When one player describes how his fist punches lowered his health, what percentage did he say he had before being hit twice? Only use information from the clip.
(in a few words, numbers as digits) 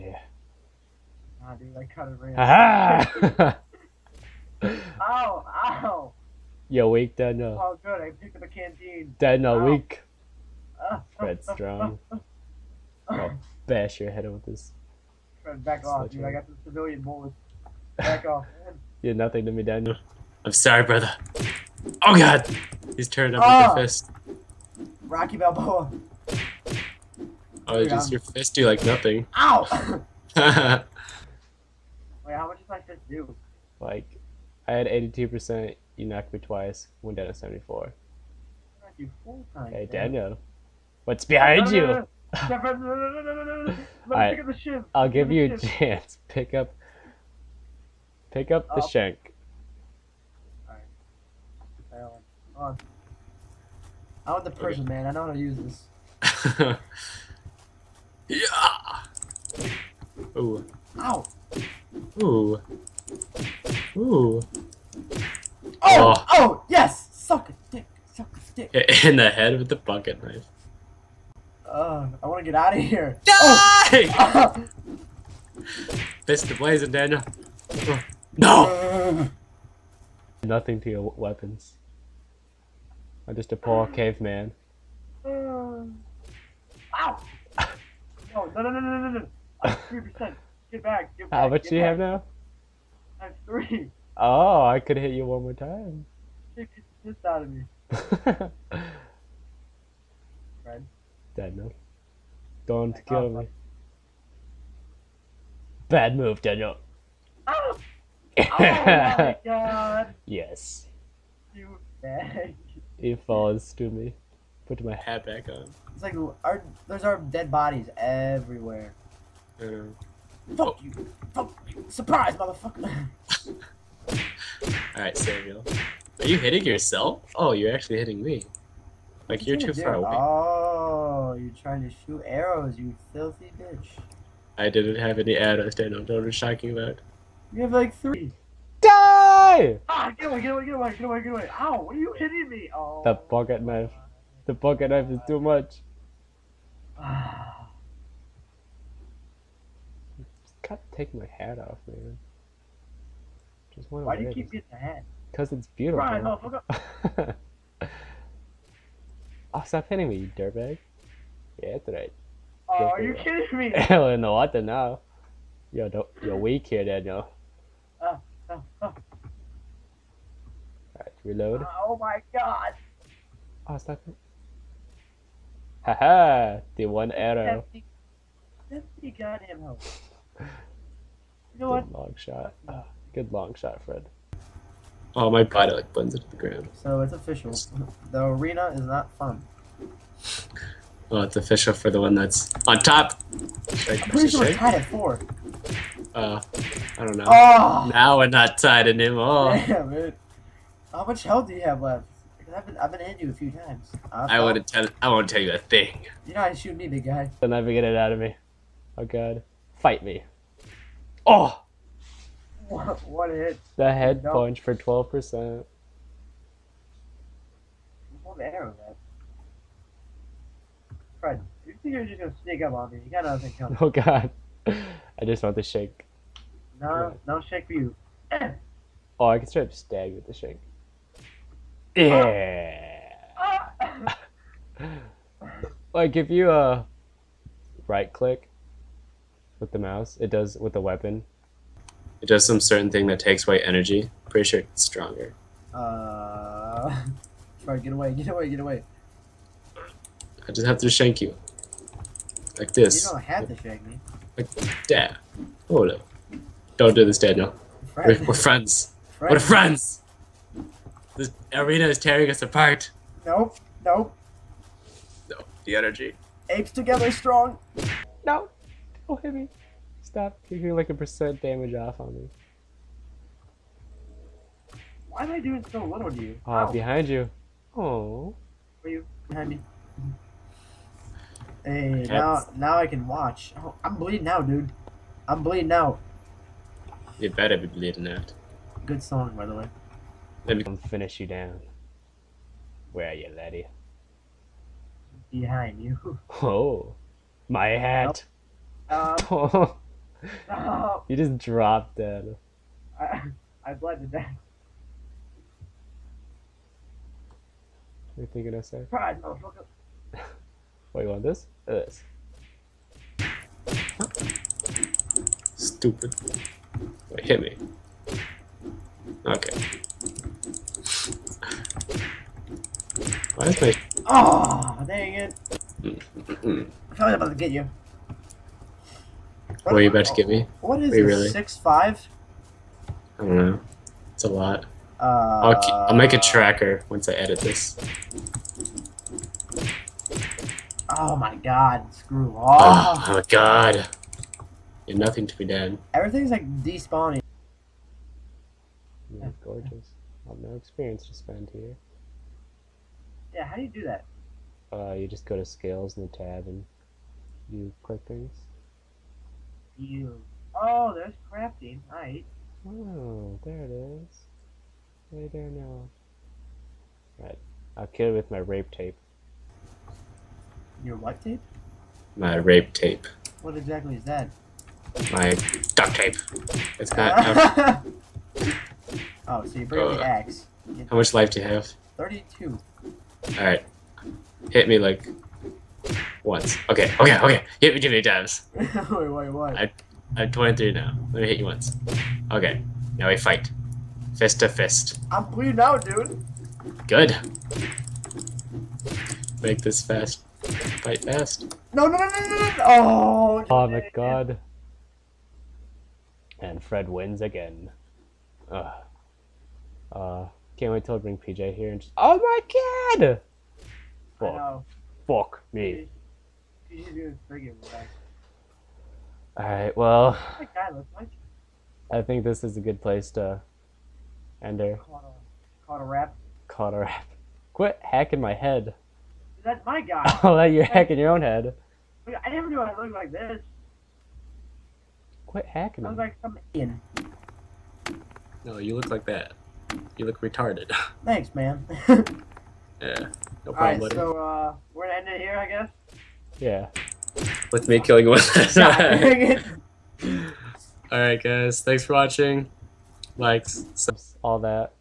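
82%.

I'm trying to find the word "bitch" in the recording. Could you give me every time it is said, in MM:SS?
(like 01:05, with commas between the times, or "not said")
02:13.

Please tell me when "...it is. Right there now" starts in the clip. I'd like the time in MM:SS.
06:03.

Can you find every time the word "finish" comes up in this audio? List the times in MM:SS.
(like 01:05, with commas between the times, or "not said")
04:50.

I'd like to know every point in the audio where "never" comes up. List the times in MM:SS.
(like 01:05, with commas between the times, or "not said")
03:27, 07:12.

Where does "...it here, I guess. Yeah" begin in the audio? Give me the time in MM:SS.
07:25.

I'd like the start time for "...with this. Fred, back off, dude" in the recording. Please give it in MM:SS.
00:14.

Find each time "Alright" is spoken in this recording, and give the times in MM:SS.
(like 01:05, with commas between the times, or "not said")
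00:42, 00:50, 06:23, 06:59, 07:23, 07:30.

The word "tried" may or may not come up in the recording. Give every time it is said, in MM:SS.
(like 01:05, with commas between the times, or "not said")
not said.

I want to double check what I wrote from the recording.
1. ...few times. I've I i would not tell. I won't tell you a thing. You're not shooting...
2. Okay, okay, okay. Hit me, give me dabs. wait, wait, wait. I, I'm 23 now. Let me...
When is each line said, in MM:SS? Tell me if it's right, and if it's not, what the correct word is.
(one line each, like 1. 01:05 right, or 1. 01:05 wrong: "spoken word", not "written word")
1. 03:23 right
2. 06:26 right.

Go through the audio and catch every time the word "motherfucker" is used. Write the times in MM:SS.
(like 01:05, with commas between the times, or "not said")
02:02, 05:09.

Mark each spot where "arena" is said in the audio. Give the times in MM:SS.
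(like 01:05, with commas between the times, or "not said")
03:08, 04:21.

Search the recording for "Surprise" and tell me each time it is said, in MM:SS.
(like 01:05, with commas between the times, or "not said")
02:01, 05:08.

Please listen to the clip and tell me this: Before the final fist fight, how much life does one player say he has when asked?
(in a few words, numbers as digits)
32.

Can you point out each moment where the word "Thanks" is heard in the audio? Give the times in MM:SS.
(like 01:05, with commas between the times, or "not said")
07:21, 07:31.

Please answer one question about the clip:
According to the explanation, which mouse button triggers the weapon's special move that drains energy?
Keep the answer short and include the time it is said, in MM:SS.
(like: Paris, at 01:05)
right click, at 03:57.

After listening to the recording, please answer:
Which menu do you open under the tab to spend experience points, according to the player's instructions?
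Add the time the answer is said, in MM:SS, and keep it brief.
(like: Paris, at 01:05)
scales, at 05:55.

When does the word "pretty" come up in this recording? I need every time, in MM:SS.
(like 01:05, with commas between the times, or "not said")
03:14, 04:04.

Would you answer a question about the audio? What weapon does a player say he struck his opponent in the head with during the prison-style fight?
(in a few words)
bucket knife.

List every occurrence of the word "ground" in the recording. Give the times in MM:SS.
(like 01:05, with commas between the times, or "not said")
03:06.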